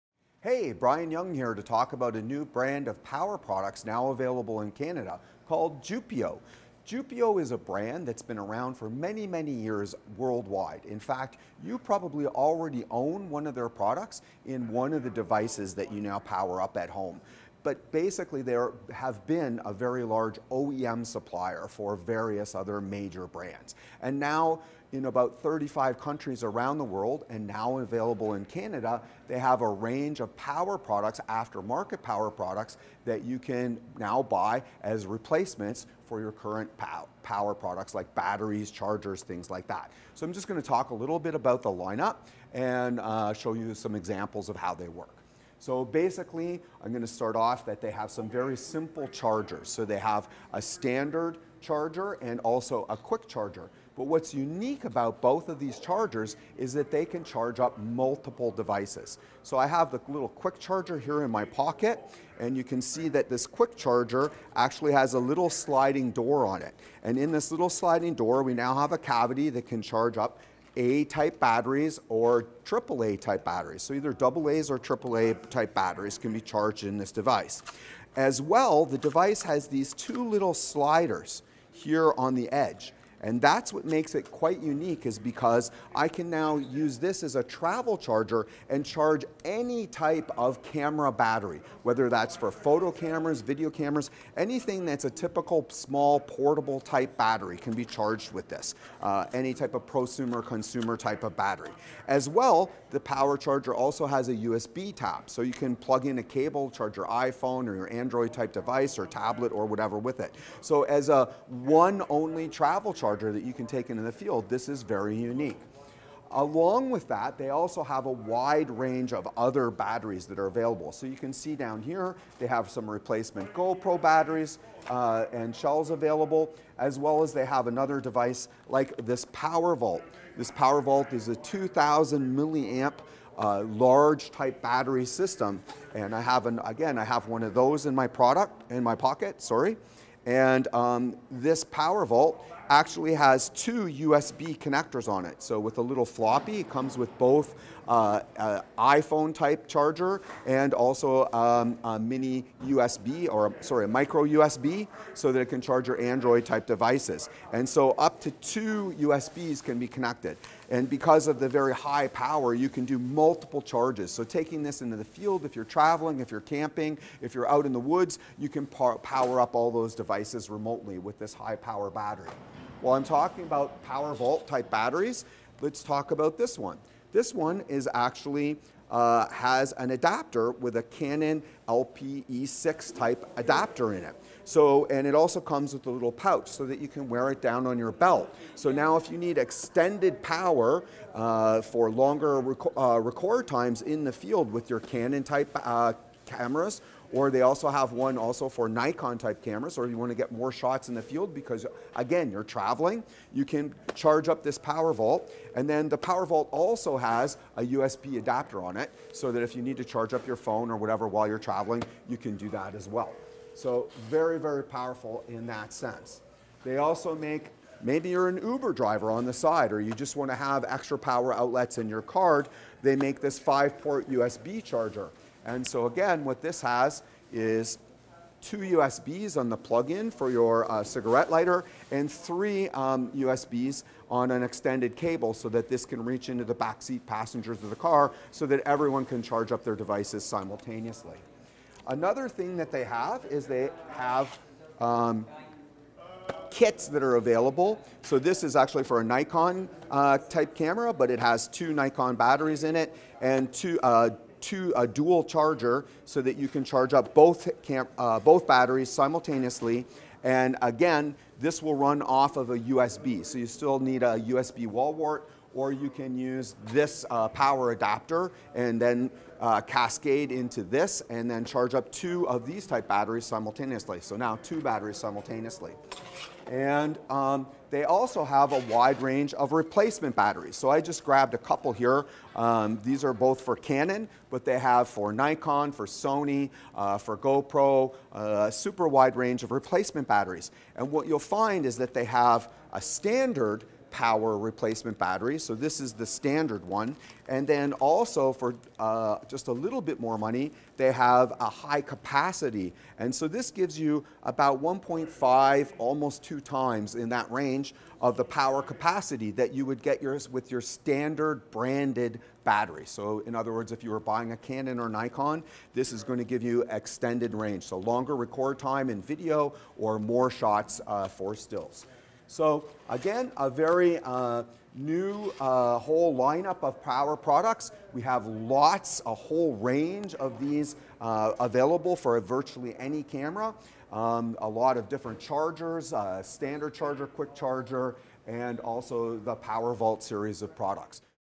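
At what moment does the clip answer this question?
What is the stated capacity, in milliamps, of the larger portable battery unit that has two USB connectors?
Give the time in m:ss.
2:11.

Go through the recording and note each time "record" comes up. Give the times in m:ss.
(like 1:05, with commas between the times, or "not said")
3:12, 5:18.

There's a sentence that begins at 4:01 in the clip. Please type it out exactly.
Another thing that they have is they have um, kits that are available.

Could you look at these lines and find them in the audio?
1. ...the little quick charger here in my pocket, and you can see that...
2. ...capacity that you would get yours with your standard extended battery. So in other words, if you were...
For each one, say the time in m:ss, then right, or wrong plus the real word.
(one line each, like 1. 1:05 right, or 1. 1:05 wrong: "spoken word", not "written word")
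1. 0:59 right
2. 5:08 wrong: "branded", not "extended".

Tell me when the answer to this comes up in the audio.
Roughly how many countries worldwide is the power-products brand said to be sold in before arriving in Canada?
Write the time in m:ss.
0:25.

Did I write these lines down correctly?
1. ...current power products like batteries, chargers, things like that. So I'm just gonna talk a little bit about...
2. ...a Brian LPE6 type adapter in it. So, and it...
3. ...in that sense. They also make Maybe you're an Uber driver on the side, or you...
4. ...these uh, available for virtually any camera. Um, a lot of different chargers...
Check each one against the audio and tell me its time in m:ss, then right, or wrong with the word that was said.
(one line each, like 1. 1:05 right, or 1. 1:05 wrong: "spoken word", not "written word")
1. 0:36 right
2. 3:00 wrong: "Canon", not "Brian"
3. 3:35 right
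4. 5:30 right.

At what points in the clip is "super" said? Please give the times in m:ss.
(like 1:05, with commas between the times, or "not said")
4:48.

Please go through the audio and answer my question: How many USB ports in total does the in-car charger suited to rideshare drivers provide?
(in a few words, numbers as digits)
5.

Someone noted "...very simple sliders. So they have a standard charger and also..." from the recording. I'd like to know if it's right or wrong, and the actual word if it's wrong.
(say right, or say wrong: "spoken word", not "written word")
wrong: "chargers", not "sliders".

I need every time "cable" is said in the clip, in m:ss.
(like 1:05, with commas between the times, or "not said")
1:46, 3:54.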